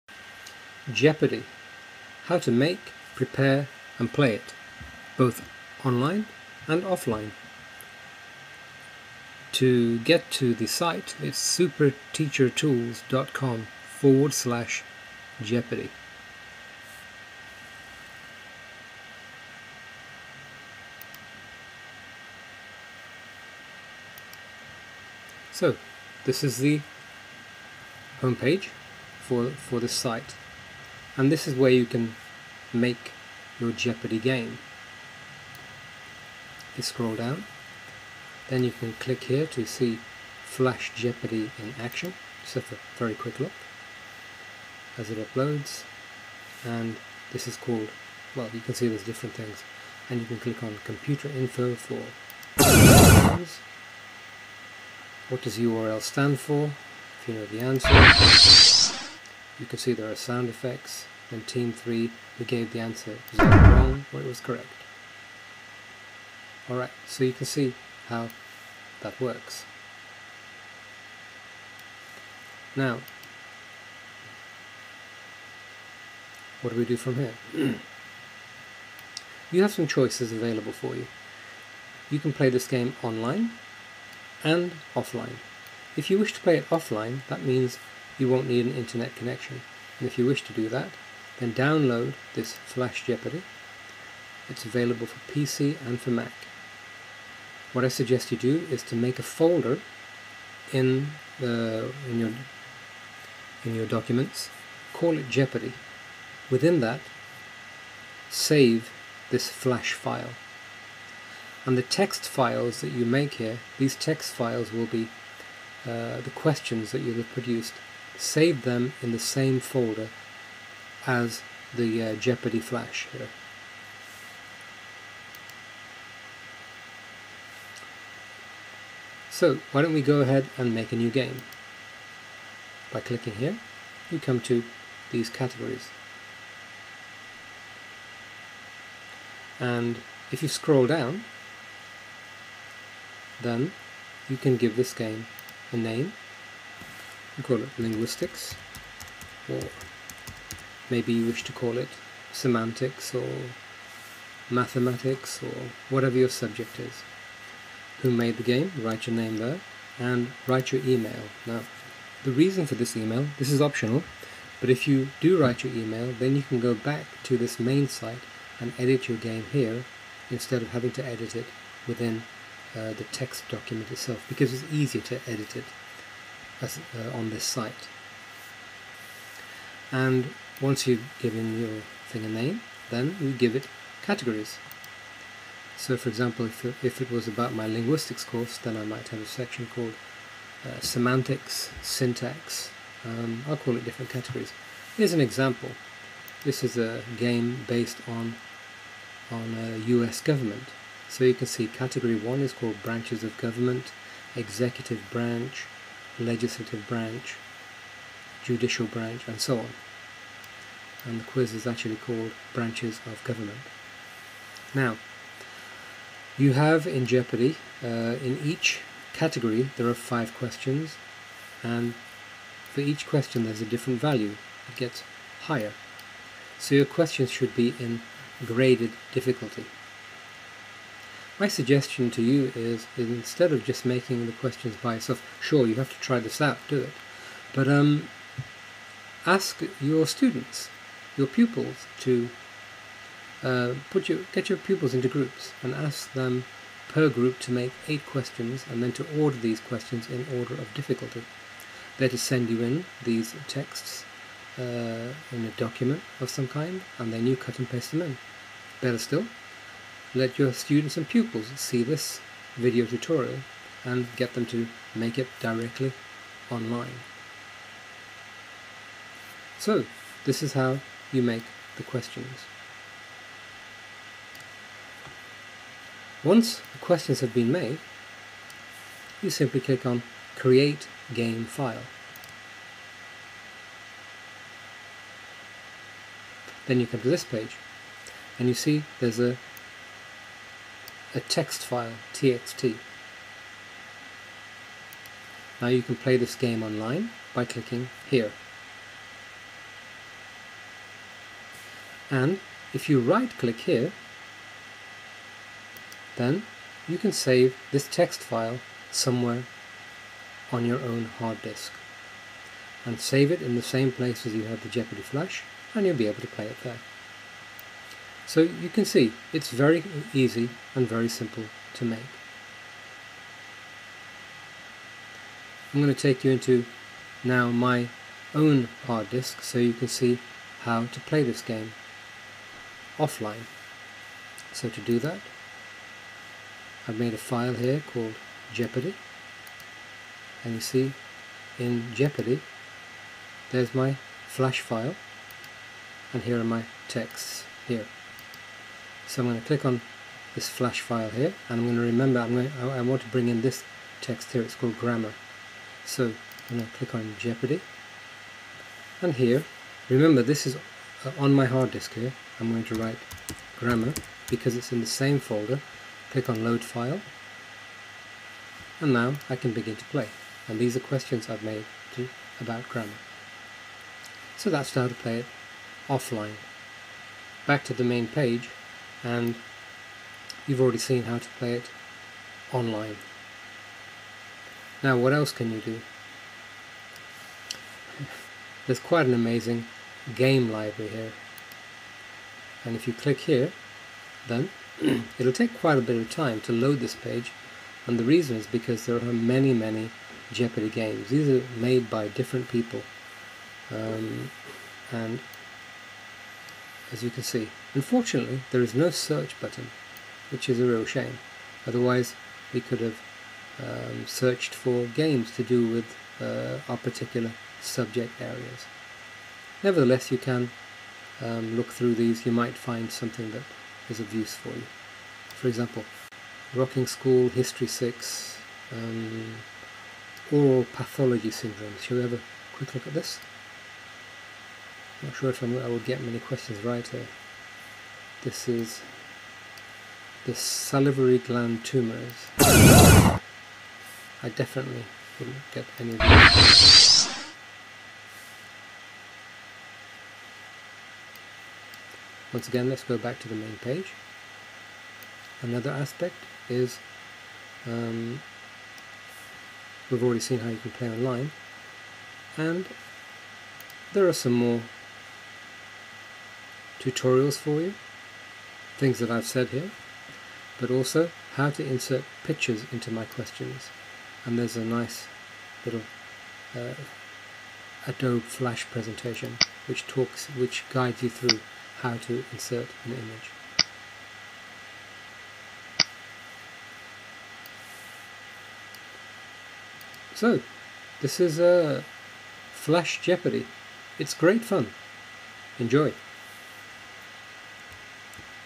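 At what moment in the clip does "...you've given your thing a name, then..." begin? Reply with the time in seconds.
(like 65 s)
180 s.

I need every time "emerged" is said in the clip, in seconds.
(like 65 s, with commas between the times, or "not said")
not said.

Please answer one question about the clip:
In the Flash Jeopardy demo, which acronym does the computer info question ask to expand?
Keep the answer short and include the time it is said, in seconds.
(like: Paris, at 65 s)
URL, at 55 s.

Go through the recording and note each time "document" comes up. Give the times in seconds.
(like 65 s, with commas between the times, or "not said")
103 s, 173 s, 255 s.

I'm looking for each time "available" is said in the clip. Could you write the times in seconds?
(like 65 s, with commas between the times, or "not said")
80 s, 94 s.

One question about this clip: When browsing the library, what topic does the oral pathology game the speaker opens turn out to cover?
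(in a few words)
salivary gland tumours.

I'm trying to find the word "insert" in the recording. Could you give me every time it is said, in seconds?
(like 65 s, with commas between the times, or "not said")
471 s, 482 s.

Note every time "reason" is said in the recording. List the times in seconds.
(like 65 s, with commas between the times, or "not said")
162 s, 398 s.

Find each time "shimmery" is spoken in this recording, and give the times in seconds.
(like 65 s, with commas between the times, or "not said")
not said.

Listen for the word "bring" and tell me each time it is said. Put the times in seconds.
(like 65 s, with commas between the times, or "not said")
353 s.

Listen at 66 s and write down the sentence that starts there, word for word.
Alright, so you can see how that works.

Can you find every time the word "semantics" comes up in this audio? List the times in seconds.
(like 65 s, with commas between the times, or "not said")
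152 s, 190 s.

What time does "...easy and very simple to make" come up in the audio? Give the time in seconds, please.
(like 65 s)
320 s.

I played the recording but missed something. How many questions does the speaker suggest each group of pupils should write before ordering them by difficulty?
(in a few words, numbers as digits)
8.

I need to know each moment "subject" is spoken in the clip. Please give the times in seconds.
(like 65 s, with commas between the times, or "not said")
156 s, 417 s.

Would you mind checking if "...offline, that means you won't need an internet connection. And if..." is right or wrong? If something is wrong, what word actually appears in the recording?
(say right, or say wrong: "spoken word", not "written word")
right.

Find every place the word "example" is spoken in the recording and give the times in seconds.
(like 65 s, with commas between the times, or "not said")
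186 s, 195 s, 425 s.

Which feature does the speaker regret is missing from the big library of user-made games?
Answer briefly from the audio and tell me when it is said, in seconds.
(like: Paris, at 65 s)
search button, at 408 s.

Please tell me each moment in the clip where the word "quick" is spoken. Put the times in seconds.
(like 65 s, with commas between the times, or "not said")
43 s, 432 s.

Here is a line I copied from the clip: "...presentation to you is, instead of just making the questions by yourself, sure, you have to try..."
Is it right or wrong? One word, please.
wrong.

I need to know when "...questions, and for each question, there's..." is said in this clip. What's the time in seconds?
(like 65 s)
220 s.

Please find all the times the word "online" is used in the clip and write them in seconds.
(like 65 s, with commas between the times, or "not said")
5 s, 83 s, 266 s, 296 s, 382 s, 460 s.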